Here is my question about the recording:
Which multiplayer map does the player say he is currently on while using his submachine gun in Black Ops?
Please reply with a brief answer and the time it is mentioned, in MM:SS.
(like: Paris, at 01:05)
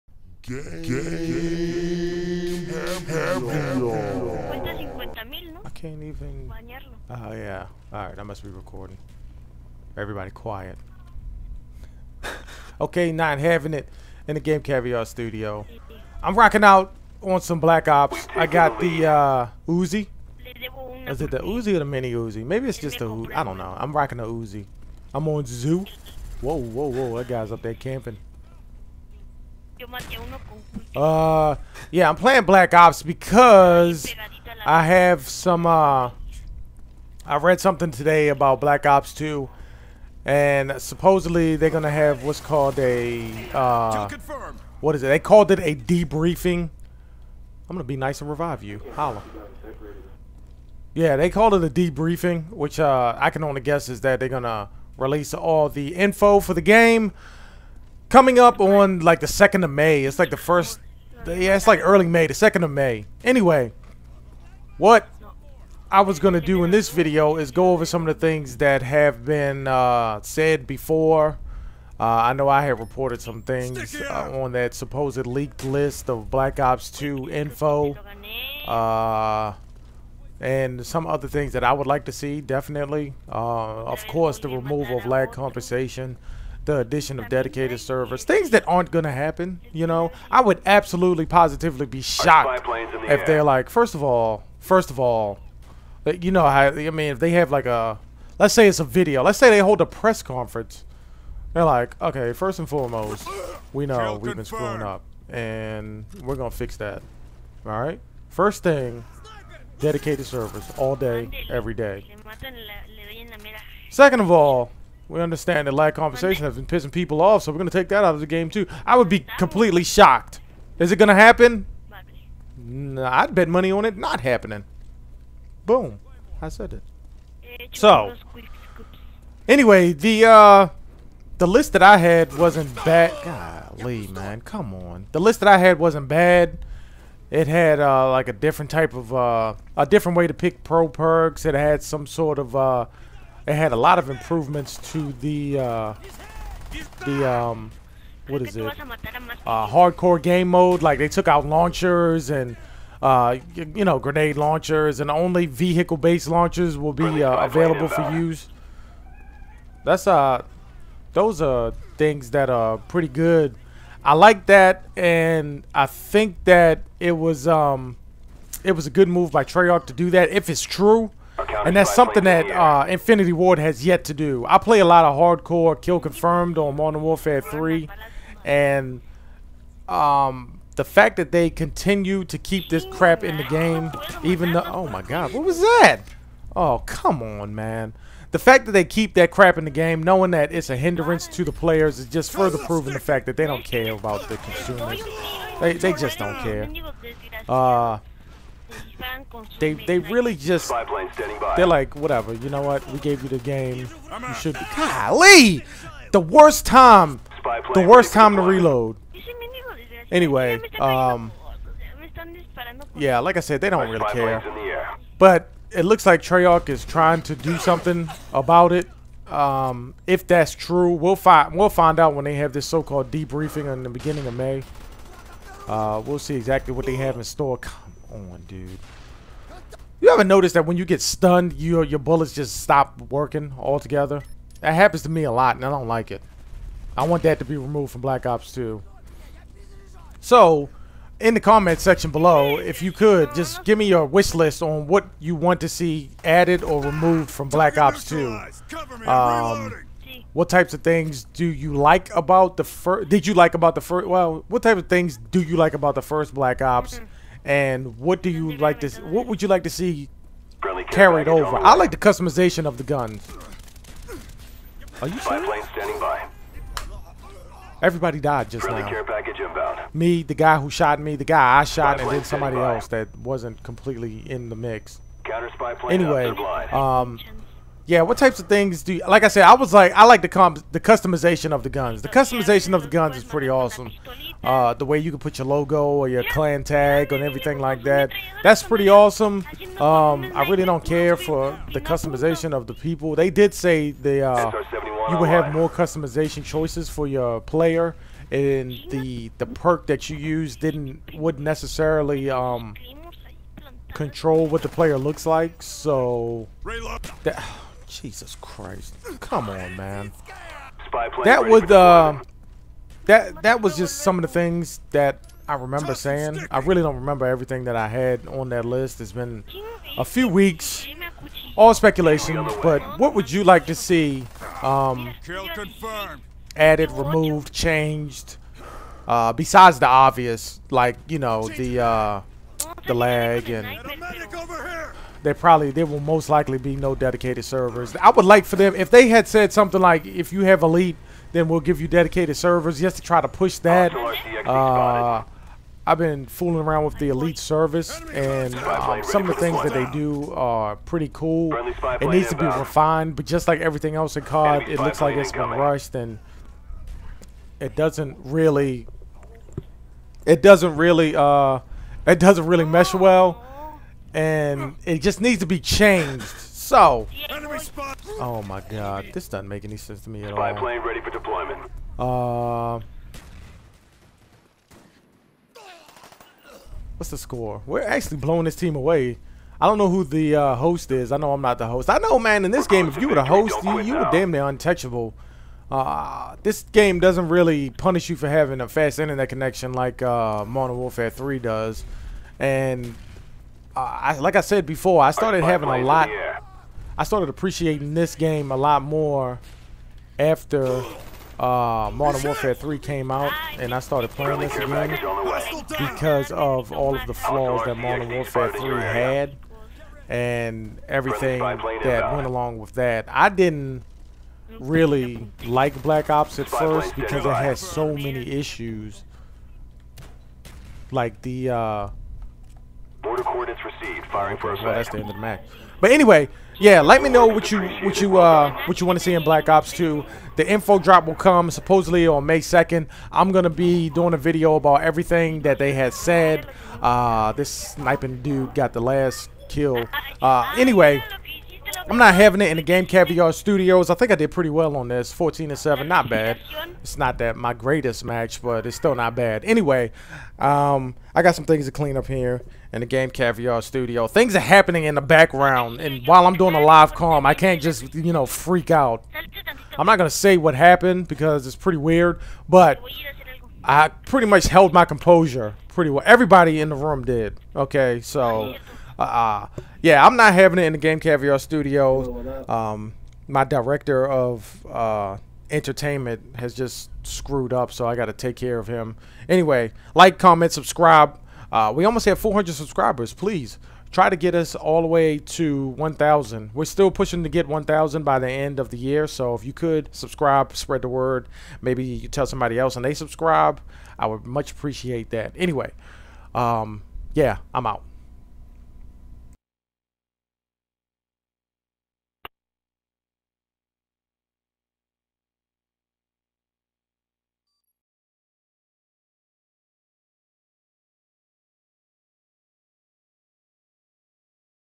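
Zoo, at 00:25.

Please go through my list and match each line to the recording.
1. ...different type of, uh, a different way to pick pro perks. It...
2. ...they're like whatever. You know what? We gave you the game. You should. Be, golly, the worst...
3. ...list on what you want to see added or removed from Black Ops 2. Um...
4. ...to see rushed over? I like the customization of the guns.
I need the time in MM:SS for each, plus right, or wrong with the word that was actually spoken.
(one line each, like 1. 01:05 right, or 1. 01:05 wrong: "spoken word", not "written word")
1. 02:18 right
2. 03:21 right
3. 04:04 right
4. 04:19 wrong: "carried", not "rushed".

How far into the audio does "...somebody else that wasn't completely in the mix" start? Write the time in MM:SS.
04:32.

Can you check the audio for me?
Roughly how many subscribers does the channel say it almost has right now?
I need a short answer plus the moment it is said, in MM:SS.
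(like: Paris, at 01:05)
400, at 08:02.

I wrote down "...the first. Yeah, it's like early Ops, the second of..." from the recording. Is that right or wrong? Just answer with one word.
wrong.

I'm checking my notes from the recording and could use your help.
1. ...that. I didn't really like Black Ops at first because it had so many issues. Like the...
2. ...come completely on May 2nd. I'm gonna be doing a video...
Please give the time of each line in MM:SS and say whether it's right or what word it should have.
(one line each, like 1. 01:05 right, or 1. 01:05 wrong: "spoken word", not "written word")
1. 06:52 right
2. 07:11 wrong: "supposedly", not "completely".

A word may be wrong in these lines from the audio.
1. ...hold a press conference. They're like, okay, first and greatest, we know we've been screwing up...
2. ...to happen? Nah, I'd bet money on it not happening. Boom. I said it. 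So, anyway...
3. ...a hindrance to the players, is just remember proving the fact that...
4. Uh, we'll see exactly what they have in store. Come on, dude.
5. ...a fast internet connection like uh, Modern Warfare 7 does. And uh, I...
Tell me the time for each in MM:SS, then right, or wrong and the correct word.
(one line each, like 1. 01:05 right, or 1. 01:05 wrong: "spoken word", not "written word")
1. 01:39 wrong: "foremost", not "greatest"
2. 02:01 right
3. 03:10 wrong: "further", not "remember"
4. 03:45 right
5. 06:28 wrong: "3", not "7".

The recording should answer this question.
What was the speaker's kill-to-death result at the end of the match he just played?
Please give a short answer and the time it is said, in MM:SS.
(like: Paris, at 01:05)
14 and 7, at 07:25.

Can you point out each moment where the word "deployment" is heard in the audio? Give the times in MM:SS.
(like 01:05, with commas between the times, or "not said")
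06:11.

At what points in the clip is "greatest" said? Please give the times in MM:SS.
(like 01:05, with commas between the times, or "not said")
07:27.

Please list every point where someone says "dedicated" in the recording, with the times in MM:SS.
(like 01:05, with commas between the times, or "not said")
01:27, 01:49, 05:36, 05:41.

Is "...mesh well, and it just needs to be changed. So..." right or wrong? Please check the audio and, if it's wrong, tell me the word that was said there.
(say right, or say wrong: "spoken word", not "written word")
right.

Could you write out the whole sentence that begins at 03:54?
That happens to me a lot, and I don't like it.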